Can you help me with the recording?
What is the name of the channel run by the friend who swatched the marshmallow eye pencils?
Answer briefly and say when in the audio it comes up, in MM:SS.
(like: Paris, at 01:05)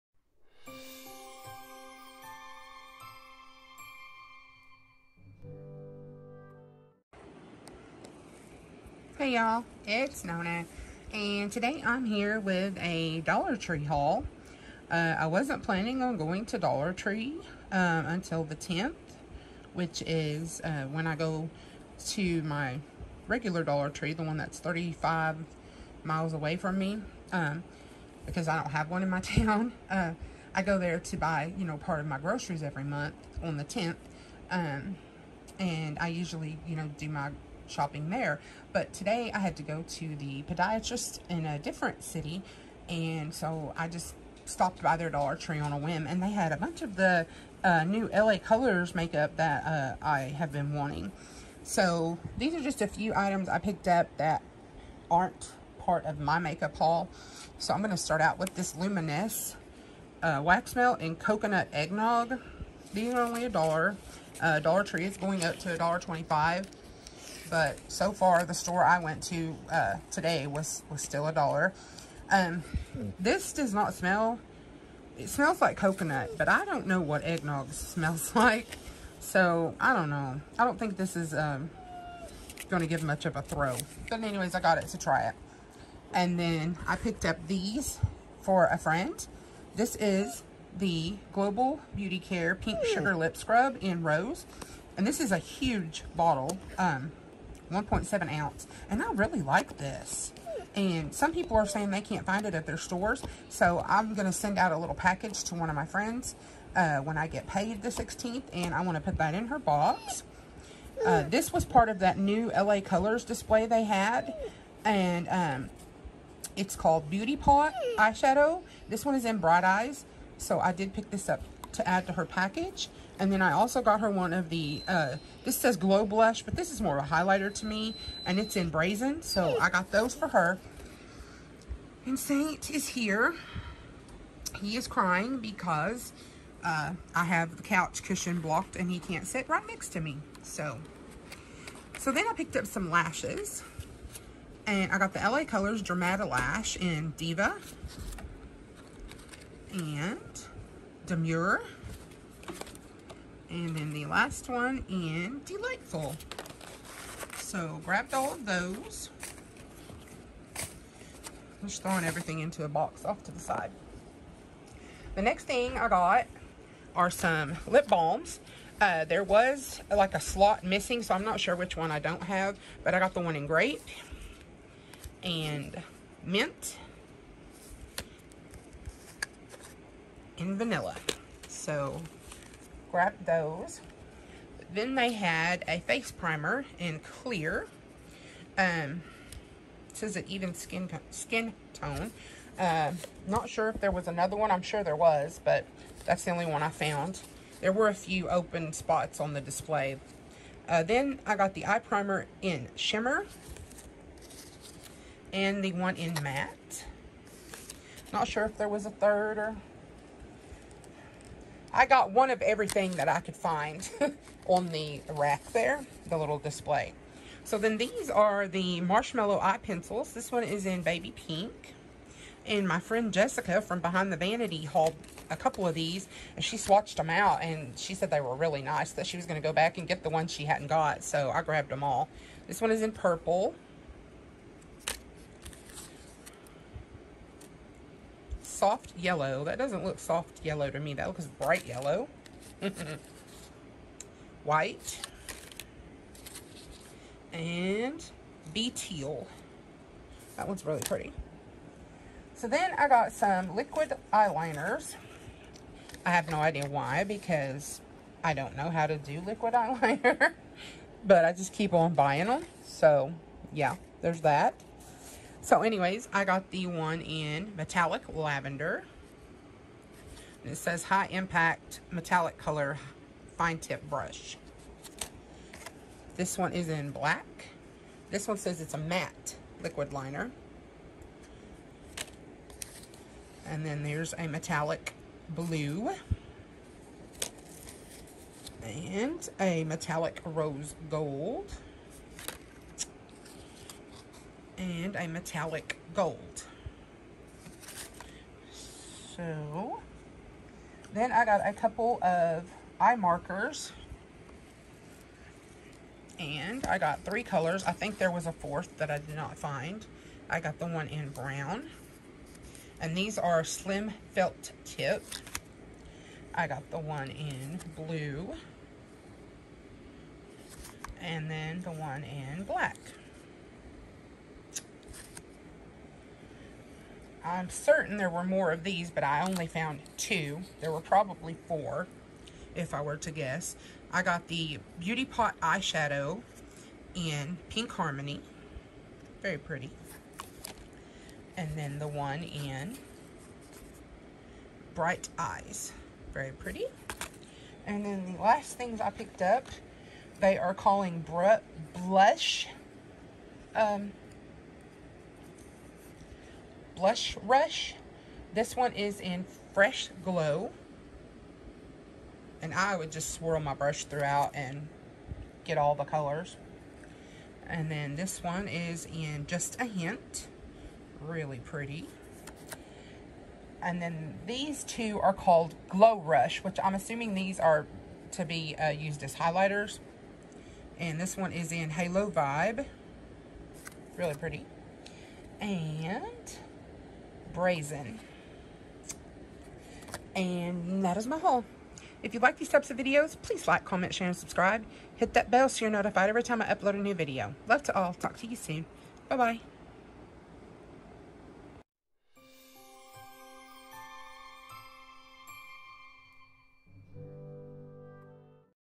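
Behind the Vanity, at 03:43.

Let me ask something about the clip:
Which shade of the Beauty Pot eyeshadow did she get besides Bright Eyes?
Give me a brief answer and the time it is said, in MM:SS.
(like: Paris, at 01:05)
Pink Harmony, at 05:37.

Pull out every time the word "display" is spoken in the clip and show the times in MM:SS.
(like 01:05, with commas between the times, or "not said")
01:53, 03:19, 03:36.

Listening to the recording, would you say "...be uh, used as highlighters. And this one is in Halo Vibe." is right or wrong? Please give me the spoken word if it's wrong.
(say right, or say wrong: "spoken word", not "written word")
right.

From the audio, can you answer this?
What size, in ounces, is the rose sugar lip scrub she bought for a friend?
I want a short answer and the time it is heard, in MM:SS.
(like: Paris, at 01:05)
1.7 ounce, at 01:37.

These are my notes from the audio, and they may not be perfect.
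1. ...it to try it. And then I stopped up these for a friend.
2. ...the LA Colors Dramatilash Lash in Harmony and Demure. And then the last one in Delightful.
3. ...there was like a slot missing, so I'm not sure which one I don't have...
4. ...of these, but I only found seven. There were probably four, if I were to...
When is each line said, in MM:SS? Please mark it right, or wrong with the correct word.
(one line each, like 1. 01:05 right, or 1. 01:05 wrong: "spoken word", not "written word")
1. 01:24 wrong: "picked", not "stopped"
2. 02:25 wrong: "Diva", not "Harmony"
3. 02:49 right
4. 05:28 wrong: "two", not "seven".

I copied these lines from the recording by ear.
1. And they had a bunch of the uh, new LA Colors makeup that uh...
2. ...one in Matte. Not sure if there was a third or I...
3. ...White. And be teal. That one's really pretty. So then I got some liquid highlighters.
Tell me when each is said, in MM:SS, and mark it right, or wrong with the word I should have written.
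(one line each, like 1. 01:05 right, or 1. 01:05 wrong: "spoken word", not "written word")
1. 00:46 right
2. 03:25 right
3. 04:04 wrong: "eyeliners", not "highlighters".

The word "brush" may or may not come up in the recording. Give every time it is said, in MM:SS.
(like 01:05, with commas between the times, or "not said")
04:33, 06:03.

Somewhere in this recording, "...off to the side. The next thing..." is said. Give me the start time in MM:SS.
02:43.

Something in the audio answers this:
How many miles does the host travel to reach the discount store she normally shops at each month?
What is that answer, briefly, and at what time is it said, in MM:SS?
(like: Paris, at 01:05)
35, at 00:24.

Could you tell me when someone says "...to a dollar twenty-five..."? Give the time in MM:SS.
01:05.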